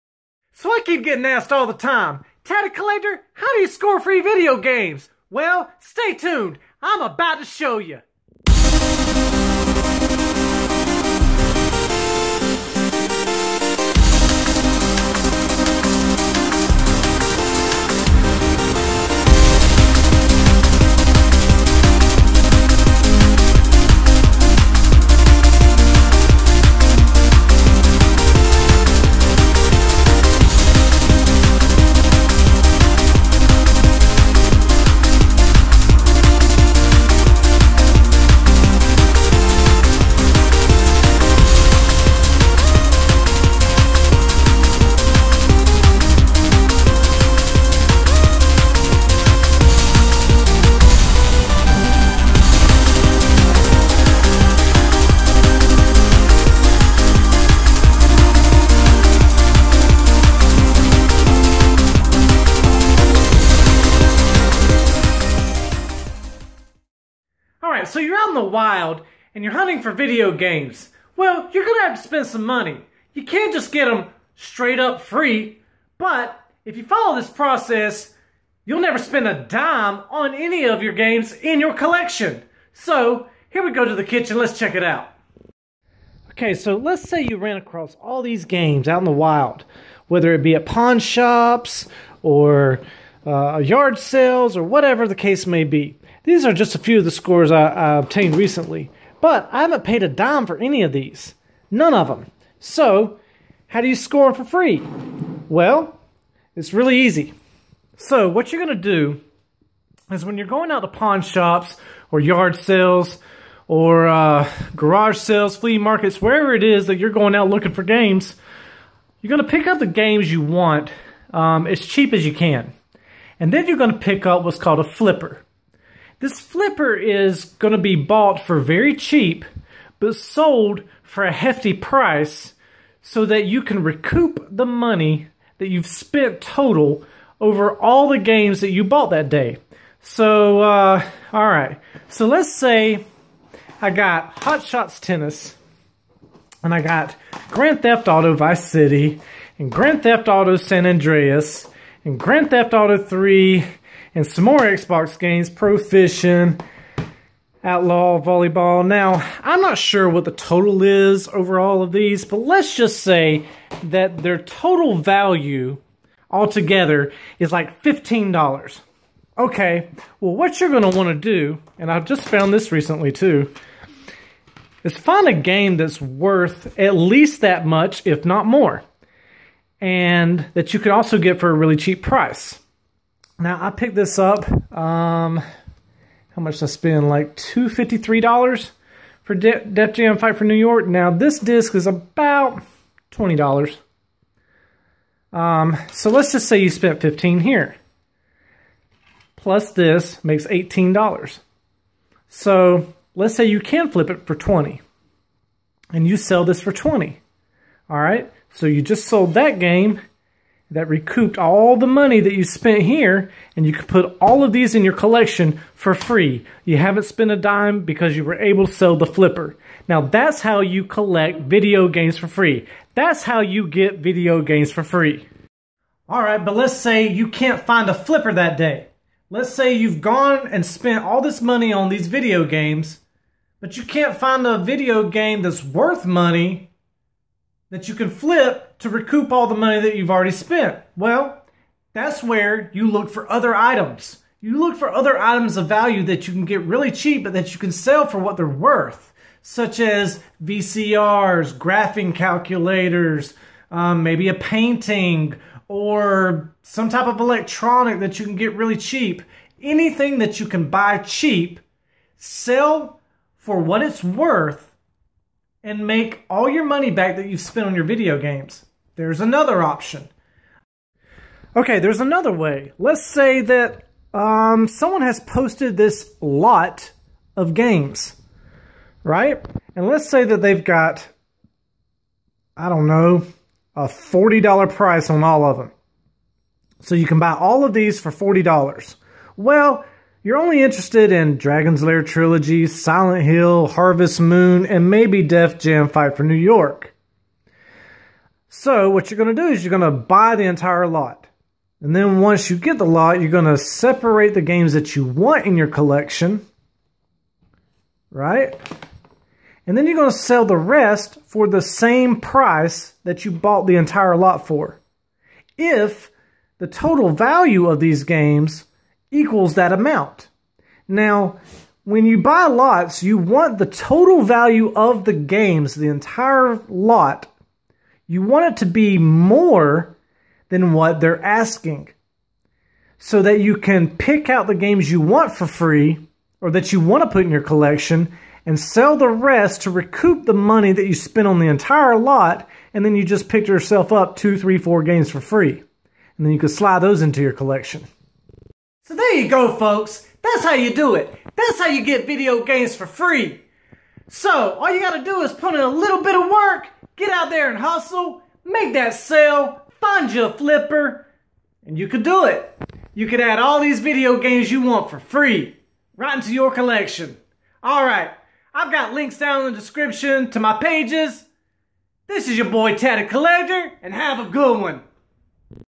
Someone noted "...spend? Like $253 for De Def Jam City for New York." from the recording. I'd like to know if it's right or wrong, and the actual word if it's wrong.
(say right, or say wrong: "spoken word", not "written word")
wrong: "Fight", not "City".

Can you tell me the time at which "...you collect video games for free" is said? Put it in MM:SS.
03:40.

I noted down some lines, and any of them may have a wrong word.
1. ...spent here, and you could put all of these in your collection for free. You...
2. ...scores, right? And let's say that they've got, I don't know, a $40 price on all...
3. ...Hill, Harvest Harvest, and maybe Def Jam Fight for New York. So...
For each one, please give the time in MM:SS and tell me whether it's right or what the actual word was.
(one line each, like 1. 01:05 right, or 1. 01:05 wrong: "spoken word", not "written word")
1. 03:32 right
2. 04:37 wrong: "games", not "scores"
3. 04:53 wrong: "Moon", not "Harvest".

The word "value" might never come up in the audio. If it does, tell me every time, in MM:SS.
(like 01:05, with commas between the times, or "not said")
02:44, 04:05, 05:17, 05:24.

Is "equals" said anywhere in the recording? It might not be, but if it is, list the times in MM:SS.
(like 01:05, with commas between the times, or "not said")
05:19.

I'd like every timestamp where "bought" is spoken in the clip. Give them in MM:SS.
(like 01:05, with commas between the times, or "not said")
02:07, 02:18, 05:13.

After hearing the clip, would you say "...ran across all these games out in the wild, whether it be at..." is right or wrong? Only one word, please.
right.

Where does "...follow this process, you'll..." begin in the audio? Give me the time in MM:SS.
01:16.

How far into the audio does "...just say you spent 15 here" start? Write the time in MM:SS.
03:16.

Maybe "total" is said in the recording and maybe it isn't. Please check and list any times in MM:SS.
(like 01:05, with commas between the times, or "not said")
02:16, 02:40, 02:44, 05:16, 05:23.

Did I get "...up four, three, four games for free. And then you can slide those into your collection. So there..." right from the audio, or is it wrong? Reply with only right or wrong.
wrong.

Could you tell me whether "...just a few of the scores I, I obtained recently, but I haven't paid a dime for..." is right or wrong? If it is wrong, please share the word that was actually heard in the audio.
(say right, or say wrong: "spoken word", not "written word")
right.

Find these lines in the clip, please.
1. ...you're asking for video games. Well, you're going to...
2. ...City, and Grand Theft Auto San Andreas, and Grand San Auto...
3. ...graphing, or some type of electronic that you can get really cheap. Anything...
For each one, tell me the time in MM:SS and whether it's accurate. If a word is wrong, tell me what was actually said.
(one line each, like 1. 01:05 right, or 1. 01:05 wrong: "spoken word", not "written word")
1. 01:09 wrong: "hunting", not "asking"
2. 02:28 wrong: "Theft", not "San"
3. 04:14 wrong: "painting", not "graphing".